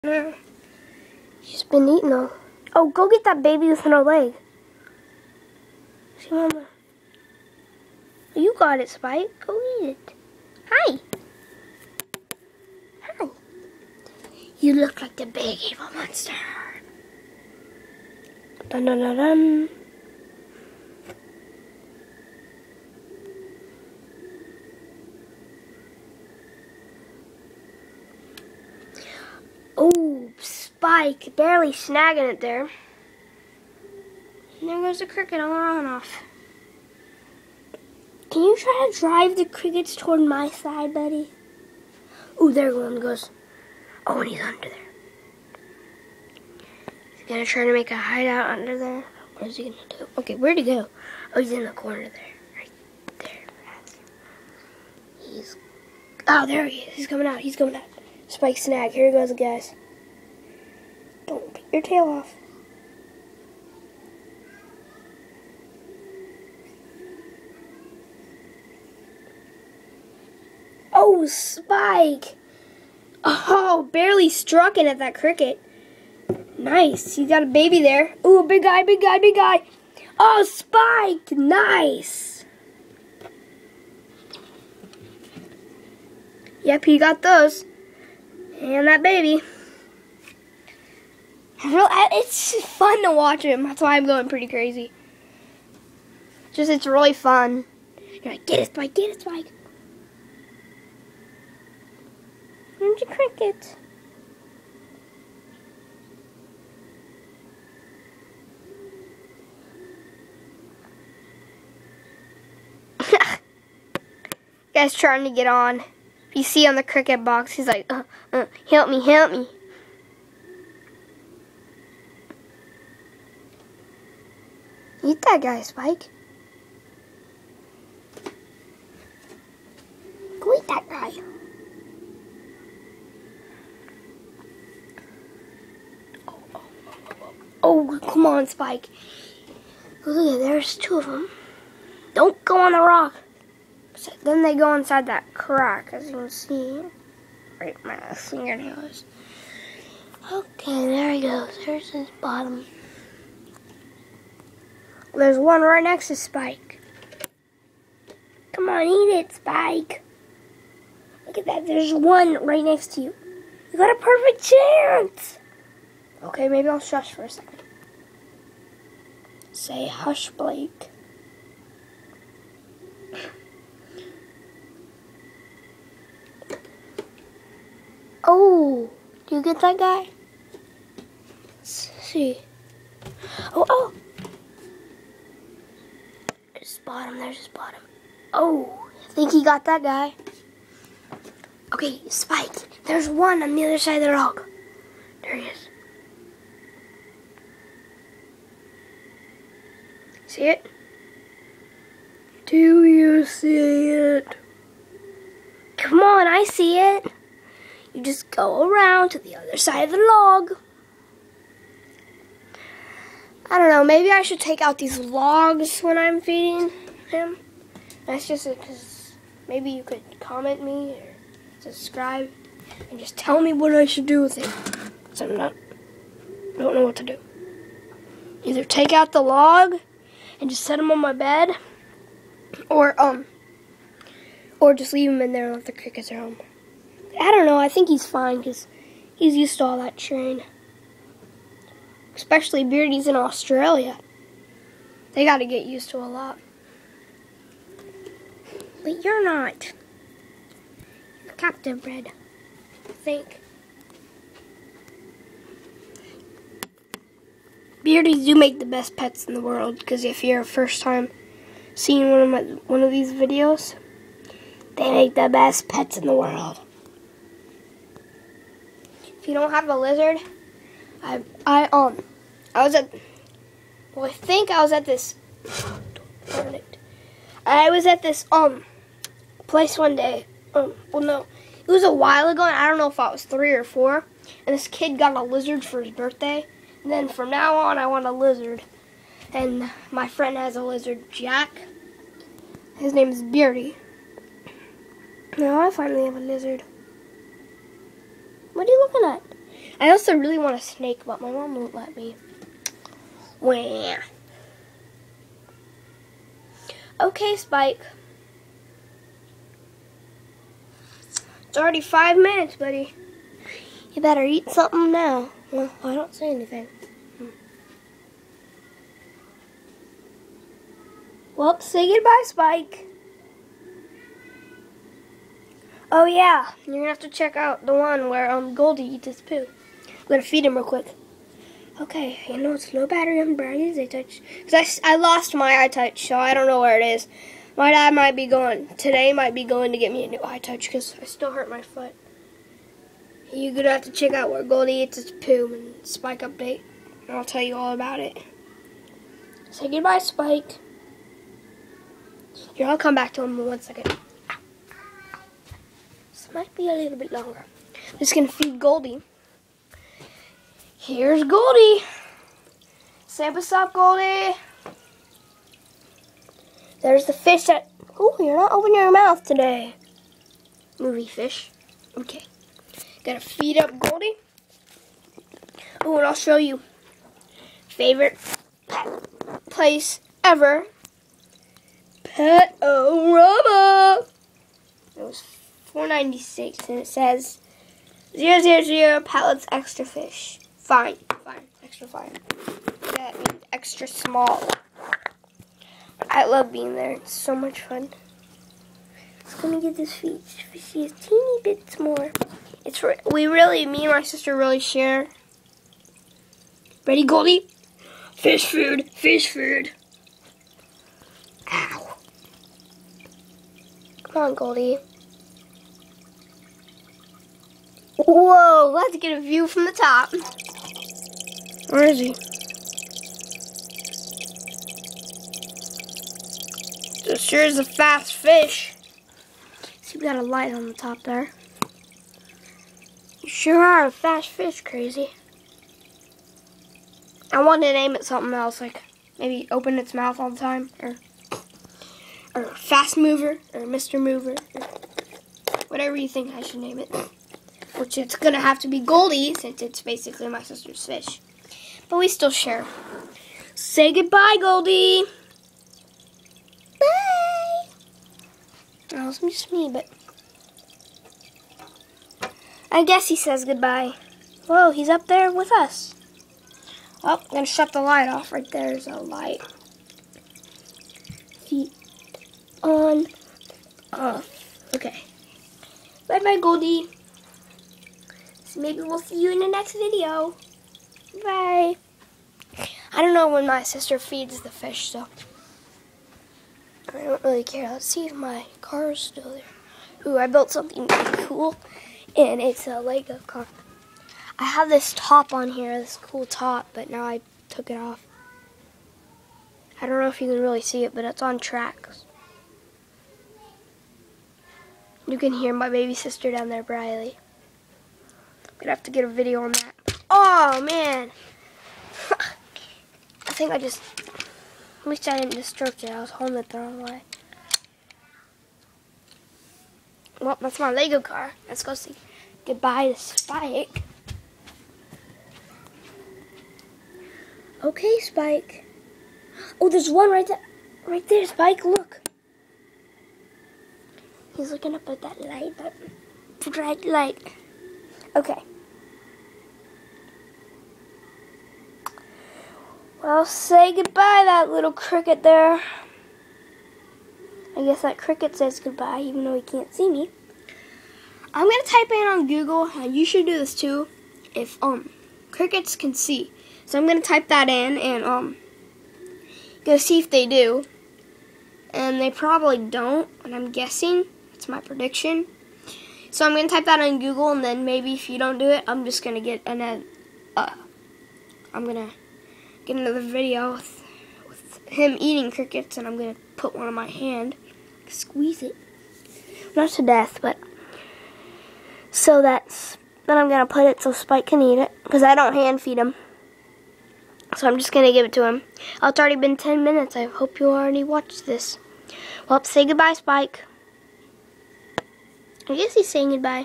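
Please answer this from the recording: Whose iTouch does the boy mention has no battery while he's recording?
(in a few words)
Brian's.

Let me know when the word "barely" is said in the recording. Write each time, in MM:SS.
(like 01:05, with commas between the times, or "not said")
00:31, 01:13.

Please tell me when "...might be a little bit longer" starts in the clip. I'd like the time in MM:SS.
05:56.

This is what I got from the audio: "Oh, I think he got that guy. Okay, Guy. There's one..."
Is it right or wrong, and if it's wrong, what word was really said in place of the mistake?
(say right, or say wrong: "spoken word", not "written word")
wrong: "Spike", not "Guy".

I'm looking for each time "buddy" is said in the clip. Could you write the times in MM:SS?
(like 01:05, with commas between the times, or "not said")
00:40, 05:12.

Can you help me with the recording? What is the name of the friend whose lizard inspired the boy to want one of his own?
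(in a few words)
Jack.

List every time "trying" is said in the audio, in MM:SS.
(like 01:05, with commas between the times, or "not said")
01:54.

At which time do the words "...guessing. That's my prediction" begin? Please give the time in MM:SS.
09:23.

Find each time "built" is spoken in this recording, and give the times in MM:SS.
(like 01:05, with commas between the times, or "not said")
08:10.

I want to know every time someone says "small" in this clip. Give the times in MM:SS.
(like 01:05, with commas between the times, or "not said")
06:33.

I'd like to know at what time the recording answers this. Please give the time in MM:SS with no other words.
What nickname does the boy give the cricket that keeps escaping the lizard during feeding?
01:42.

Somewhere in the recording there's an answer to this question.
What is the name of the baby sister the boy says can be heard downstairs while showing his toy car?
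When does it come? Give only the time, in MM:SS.
08:26.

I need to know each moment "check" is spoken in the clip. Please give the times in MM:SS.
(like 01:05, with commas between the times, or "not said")
05:27, 05:43.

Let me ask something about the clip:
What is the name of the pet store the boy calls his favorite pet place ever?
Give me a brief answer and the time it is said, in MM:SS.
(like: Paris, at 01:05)
Pet-O-Rama, at 06:22.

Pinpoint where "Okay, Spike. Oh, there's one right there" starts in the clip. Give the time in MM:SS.
08:47.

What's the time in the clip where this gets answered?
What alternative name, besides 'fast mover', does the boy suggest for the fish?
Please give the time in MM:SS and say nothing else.
07:23.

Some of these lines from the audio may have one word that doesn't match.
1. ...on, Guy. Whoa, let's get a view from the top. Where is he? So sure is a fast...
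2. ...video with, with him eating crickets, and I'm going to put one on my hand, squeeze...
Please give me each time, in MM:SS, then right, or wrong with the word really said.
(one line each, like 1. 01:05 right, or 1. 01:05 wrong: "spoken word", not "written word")
1. 06:54 wrong: "Goldie", not "Guy"
2. 09:33 right.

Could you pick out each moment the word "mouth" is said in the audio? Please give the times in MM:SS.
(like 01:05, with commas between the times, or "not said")
06:08, 07:19.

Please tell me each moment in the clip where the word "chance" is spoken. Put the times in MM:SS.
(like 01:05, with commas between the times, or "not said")
02:44.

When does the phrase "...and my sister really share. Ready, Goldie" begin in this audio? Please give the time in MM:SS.
06:43.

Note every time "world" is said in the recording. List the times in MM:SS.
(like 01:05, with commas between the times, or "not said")
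04:19, 04:26.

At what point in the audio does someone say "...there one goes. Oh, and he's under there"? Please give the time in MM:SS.
00:42.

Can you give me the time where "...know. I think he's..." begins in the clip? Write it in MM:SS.
03:57.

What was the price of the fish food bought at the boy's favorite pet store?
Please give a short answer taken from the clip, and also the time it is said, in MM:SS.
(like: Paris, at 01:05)
4.96, at 06:25.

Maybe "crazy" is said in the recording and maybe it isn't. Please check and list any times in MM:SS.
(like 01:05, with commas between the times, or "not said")
01:34, 07:14.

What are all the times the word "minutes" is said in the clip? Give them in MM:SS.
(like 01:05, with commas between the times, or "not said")
05:12, 09:49.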